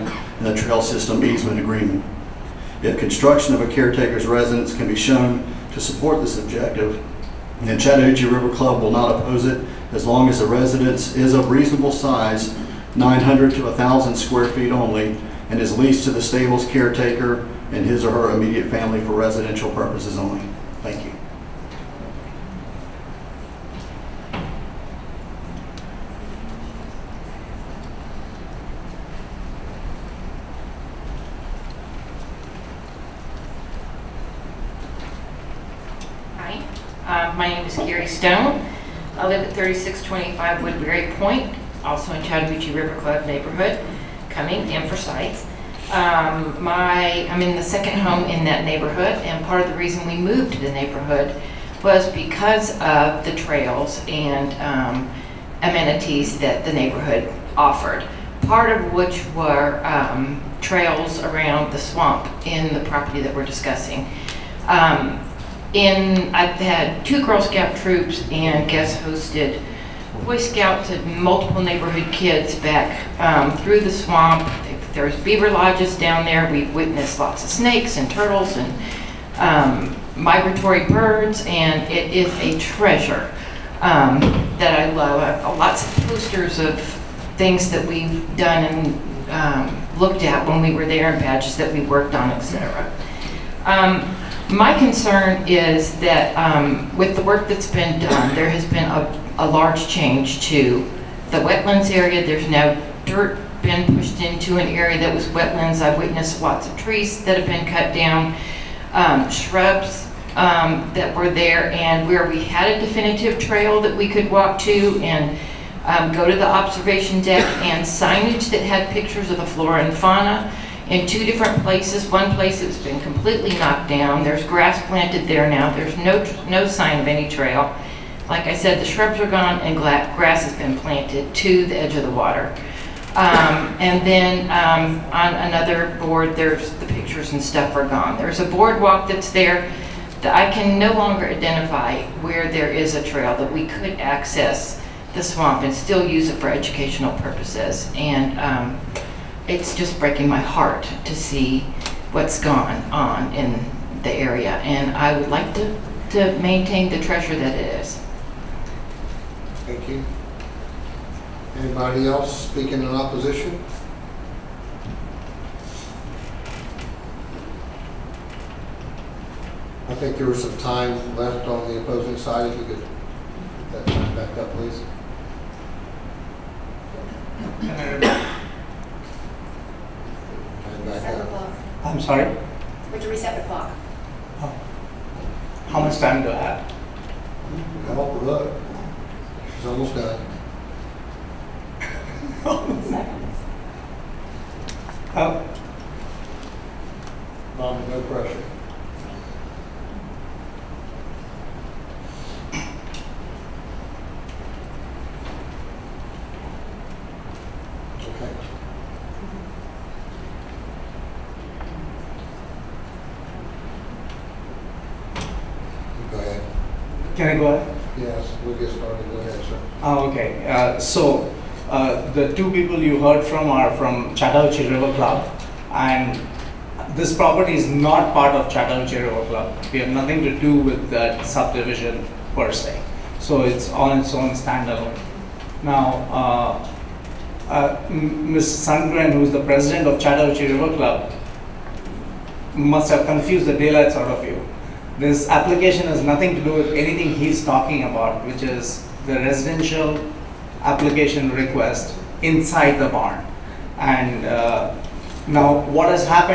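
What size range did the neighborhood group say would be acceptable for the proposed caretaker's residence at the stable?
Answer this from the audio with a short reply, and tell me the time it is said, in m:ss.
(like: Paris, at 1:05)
900 to 1,000 square feet, at 0:12.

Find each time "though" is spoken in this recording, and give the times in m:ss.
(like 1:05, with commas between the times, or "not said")
not said.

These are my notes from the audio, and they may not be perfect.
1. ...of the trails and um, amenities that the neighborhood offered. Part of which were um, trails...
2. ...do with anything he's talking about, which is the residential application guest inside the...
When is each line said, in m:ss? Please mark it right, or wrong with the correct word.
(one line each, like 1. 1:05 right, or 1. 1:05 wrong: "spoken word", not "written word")
1. 0:52 right
2. 4:06 wrong: "request", not "guest".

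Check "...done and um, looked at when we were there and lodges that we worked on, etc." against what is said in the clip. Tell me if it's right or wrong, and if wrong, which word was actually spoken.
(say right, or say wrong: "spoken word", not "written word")
wrong: "badges", not "lodges".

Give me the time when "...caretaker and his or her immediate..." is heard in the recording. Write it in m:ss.
0:16.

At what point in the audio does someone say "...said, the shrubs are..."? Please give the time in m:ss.
2:08.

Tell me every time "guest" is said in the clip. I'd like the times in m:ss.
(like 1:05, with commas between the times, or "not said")
1:08.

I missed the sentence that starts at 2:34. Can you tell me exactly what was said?
And I would like to, to maintain the treasure that it is.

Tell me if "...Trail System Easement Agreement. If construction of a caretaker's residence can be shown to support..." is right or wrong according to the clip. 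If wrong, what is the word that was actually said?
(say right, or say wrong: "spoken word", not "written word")
right.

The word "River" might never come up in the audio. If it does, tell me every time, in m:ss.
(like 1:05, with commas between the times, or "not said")
0:08, 0:42, 3:44, 3:49, 4:00.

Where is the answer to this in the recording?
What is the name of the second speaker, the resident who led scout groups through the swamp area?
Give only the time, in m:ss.
0:37.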